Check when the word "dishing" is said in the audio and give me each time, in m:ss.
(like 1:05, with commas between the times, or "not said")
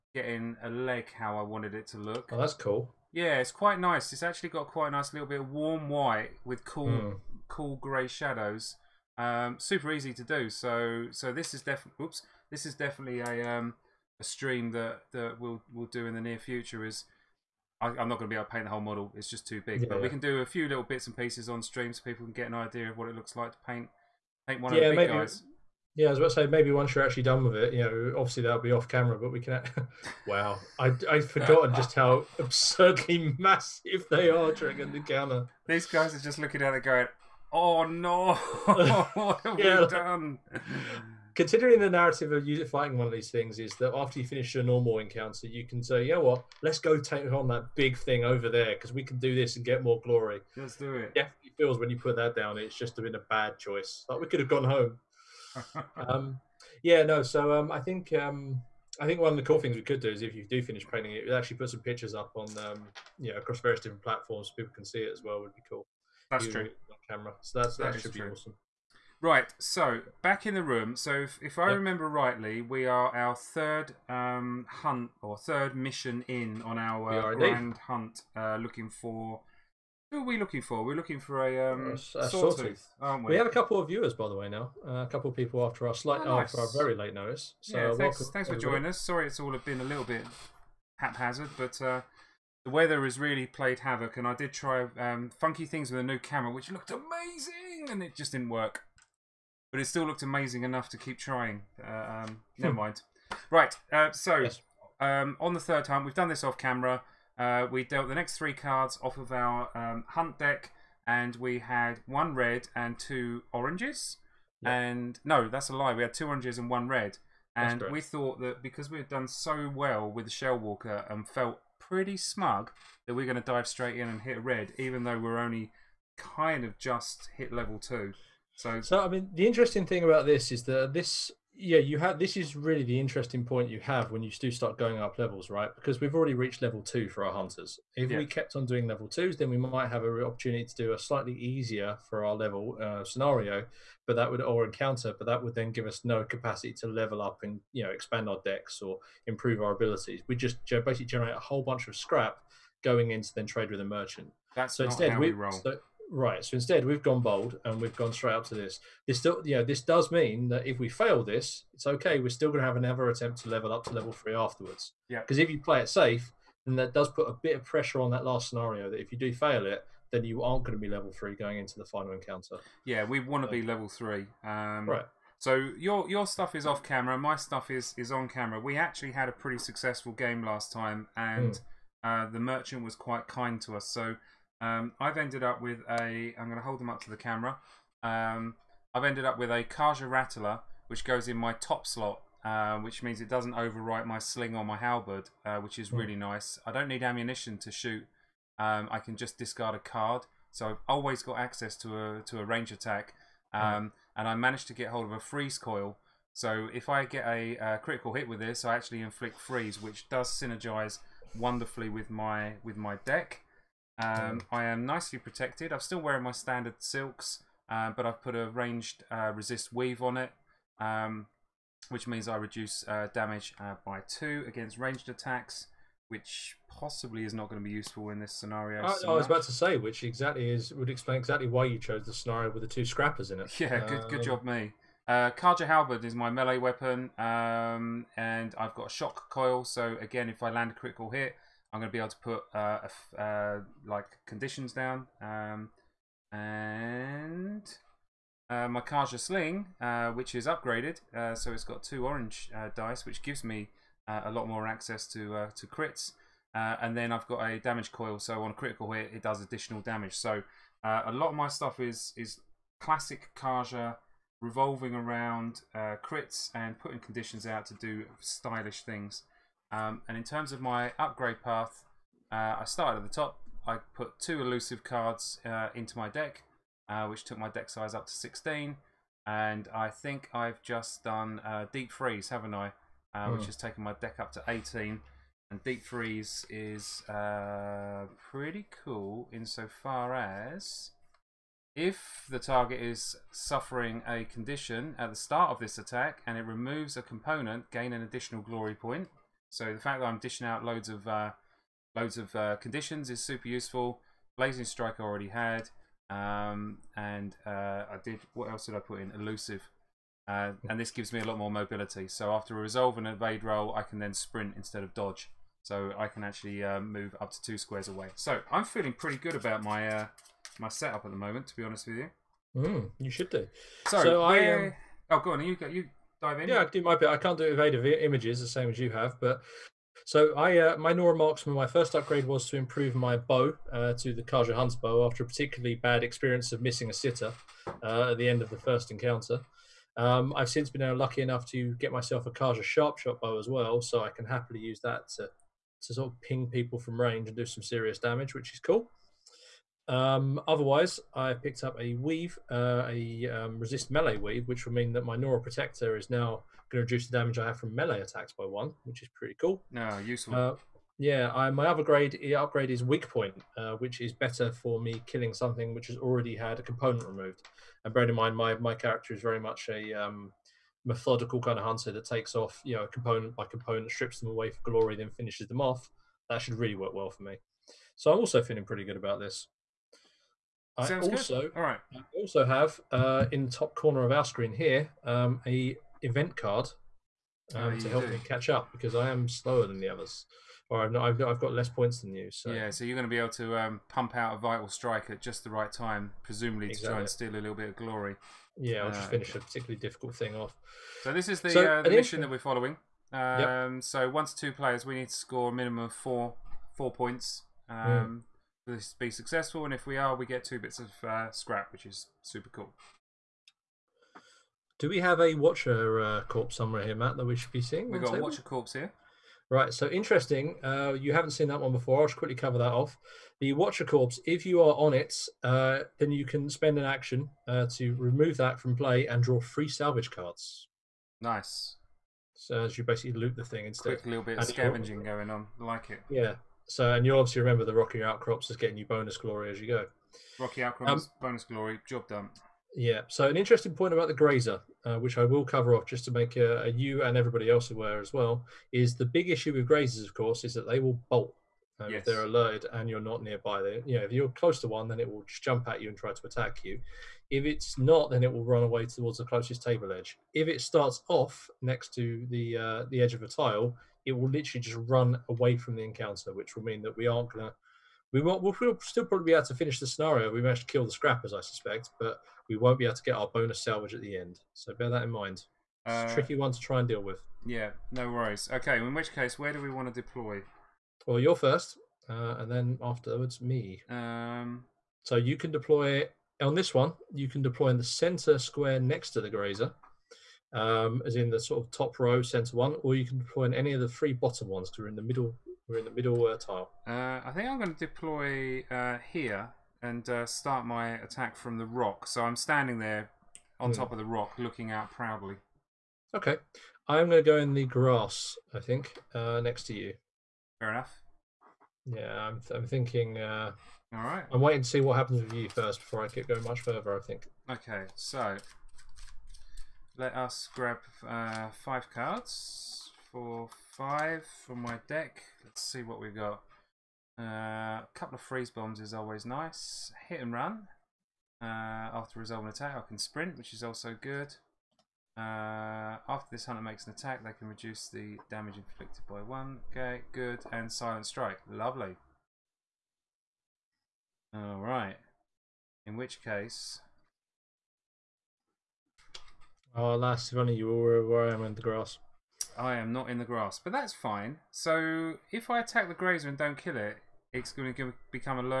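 5:00.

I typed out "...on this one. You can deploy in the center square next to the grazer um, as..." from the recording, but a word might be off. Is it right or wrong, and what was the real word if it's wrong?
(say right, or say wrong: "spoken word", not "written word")
right.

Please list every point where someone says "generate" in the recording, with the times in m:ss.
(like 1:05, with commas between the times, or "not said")
2:31.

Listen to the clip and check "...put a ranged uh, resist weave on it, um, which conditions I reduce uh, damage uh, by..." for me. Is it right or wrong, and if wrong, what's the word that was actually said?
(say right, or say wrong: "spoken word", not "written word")
wrong: "means", not "conditions".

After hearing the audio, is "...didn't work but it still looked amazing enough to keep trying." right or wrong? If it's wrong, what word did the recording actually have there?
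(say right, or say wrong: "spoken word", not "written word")
right.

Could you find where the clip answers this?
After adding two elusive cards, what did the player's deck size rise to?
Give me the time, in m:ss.
4:38.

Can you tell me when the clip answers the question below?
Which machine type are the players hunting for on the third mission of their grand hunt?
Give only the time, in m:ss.
1:22.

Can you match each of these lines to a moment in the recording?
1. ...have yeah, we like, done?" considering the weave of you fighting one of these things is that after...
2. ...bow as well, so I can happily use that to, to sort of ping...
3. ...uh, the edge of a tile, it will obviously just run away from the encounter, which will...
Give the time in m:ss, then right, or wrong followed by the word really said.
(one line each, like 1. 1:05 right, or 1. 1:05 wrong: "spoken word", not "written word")
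1. 0:39 wrong: "narrative", not "weave"
2. 5:43 right
3. 7:42 wrong: "literally", not "obviously".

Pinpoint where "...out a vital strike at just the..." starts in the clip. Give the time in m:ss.
6:34.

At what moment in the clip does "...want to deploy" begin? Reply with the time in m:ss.
7:59.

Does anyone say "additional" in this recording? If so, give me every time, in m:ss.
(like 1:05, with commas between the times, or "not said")
4:19, 4:58.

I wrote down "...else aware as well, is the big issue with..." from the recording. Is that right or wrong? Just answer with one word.
right.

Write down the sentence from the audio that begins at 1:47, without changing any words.
Uh, we dealt the next three cards off of our um, hunt deck, and we had one red and two oranges.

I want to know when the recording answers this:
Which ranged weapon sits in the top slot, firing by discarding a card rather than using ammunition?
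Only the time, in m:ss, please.
3:09.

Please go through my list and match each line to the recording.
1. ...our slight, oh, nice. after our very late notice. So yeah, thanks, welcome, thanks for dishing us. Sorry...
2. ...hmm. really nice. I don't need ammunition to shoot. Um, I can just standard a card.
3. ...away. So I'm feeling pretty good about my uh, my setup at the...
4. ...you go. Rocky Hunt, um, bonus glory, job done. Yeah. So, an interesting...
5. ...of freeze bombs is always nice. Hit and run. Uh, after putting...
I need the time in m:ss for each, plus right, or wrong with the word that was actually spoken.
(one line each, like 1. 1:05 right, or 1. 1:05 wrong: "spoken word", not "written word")
1. 1:25 wrong: "joining", not "dishing"
2. 3:15 wrong: "discard", not "standard"
3. 5:17 right
4. 7:19 wrong: "Outcrops", not "Hunt"
5. 8:48 wrong: "resolving", not "putting".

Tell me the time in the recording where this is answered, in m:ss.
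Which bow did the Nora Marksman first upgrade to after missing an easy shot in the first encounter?
5:34.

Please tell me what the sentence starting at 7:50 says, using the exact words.
We managed to kill the scrappers, I suspect, but we won't be able to get our bonus salvage at the end.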